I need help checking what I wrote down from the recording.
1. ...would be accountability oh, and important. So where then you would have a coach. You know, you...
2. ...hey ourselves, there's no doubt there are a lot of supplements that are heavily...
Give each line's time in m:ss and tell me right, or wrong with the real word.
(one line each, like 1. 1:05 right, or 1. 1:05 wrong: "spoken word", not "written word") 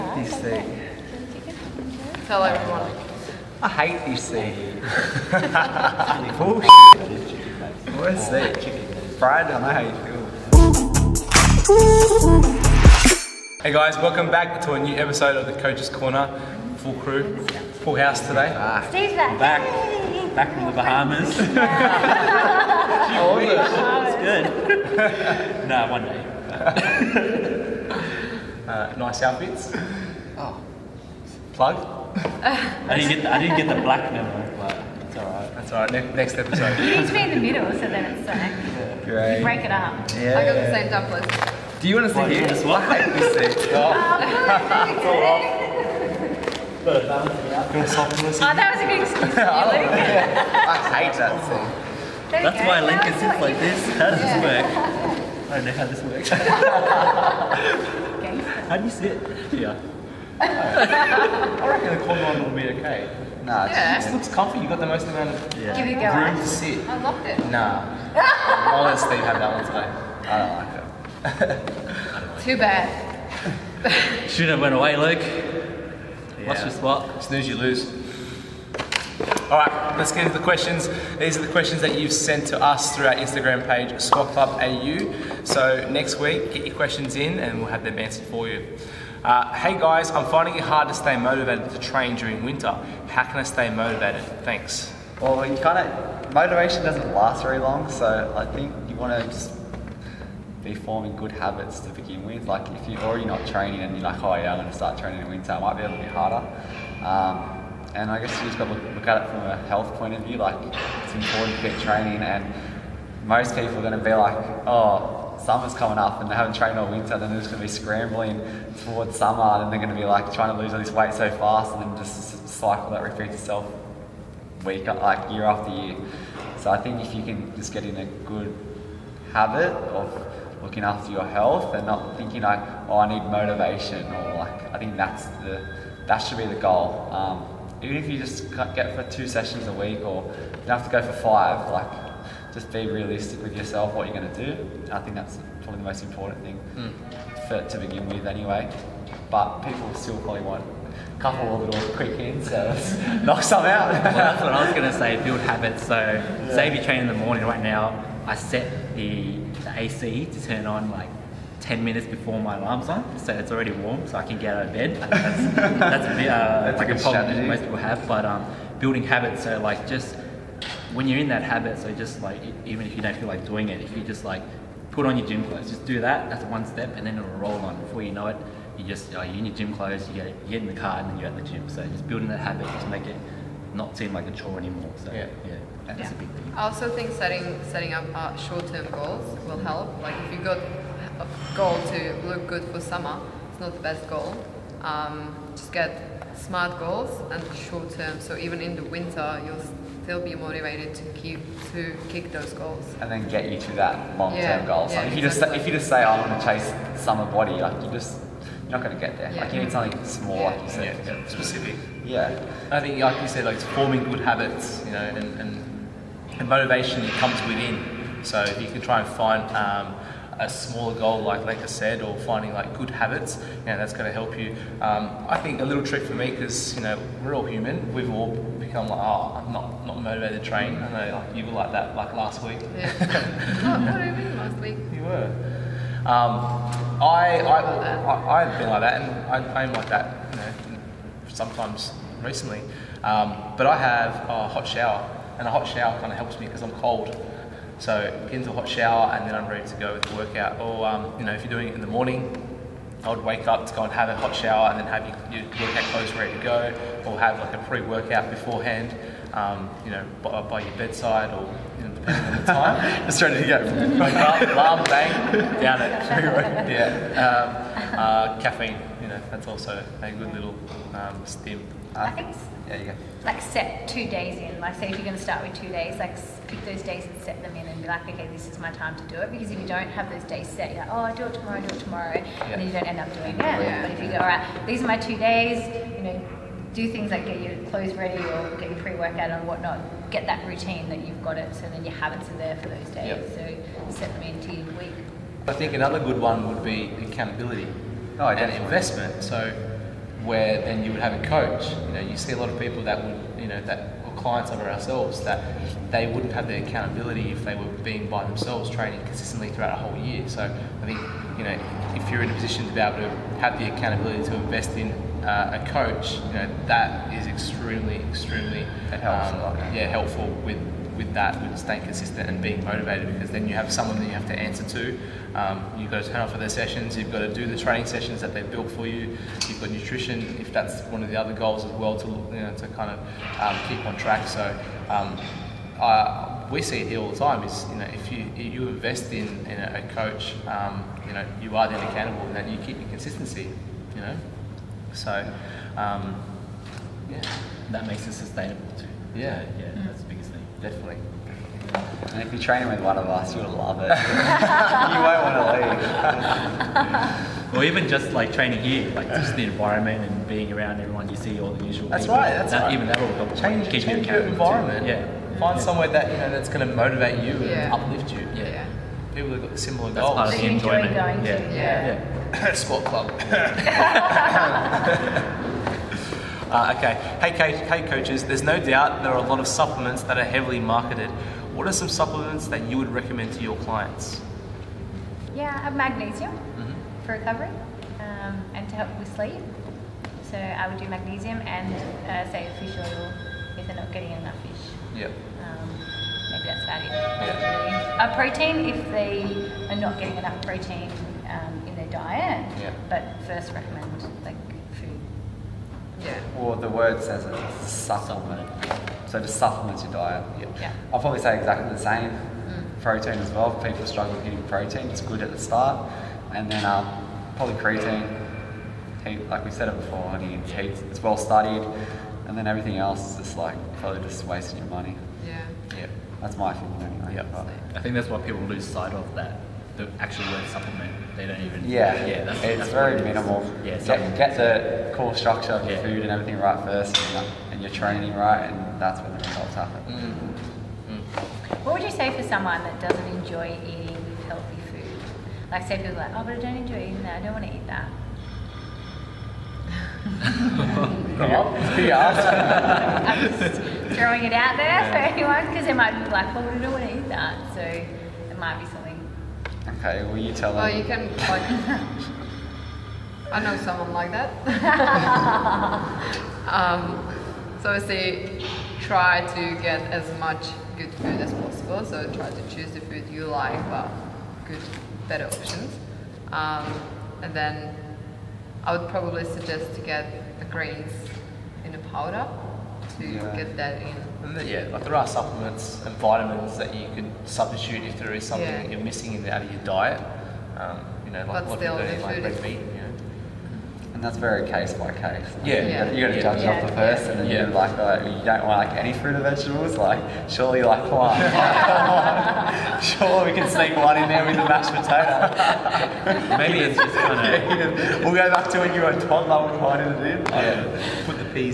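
1. 4:56 wrong: "investment", not "important"
2. 6:17 wrong: "coaches", not "ourselves".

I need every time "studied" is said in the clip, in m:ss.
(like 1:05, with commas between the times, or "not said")
7:01.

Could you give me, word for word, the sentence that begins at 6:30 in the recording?
So I would do magnesium and uh, say fish oil if they're not getting enough fish.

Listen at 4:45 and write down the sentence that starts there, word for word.
You know, do things like get your clothes ready or get your pre-workout and whatnot.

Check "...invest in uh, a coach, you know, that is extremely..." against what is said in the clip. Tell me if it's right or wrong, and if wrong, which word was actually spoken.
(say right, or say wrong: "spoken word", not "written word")
right.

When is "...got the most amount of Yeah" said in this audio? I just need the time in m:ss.
1:04.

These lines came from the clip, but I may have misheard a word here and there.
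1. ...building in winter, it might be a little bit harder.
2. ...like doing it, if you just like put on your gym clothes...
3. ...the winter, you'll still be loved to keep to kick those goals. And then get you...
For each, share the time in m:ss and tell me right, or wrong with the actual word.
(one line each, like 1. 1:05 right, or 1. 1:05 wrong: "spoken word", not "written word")
1. 1:44 wrong: "training", not "building"
2. 2:53 right
3. 3:18 wrong: "motivated", not "loved".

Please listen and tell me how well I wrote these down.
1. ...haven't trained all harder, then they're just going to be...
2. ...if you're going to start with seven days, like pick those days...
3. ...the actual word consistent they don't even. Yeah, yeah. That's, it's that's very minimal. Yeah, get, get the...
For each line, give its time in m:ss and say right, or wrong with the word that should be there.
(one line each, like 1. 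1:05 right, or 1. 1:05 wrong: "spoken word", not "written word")
1. 1:56 wrong: "winter", not "harder"
2. 4:34 wrong: "two", not "seven"
3. 7:09 wrong: "supplement", not "consistent".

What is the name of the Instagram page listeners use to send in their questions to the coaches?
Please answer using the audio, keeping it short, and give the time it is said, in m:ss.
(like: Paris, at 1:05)
Squat Club AU, at 1:23.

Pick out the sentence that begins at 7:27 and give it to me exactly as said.
I don't want to eat that.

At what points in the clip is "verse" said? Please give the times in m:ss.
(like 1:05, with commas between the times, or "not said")
not said.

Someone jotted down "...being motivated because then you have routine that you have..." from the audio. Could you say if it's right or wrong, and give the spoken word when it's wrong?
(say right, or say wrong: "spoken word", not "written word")
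wrong: "someone", not "routine".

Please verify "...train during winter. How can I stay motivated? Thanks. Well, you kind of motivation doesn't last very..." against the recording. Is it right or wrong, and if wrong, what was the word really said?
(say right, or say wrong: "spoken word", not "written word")
right.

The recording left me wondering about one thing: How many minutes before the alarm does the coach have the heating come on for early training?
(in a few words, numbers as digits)
10.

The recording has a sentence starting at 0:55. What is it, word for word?
I don't know how this works.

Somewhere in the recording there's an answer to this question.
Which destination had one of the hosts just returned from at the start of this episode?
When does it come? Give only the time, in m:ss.
0:20.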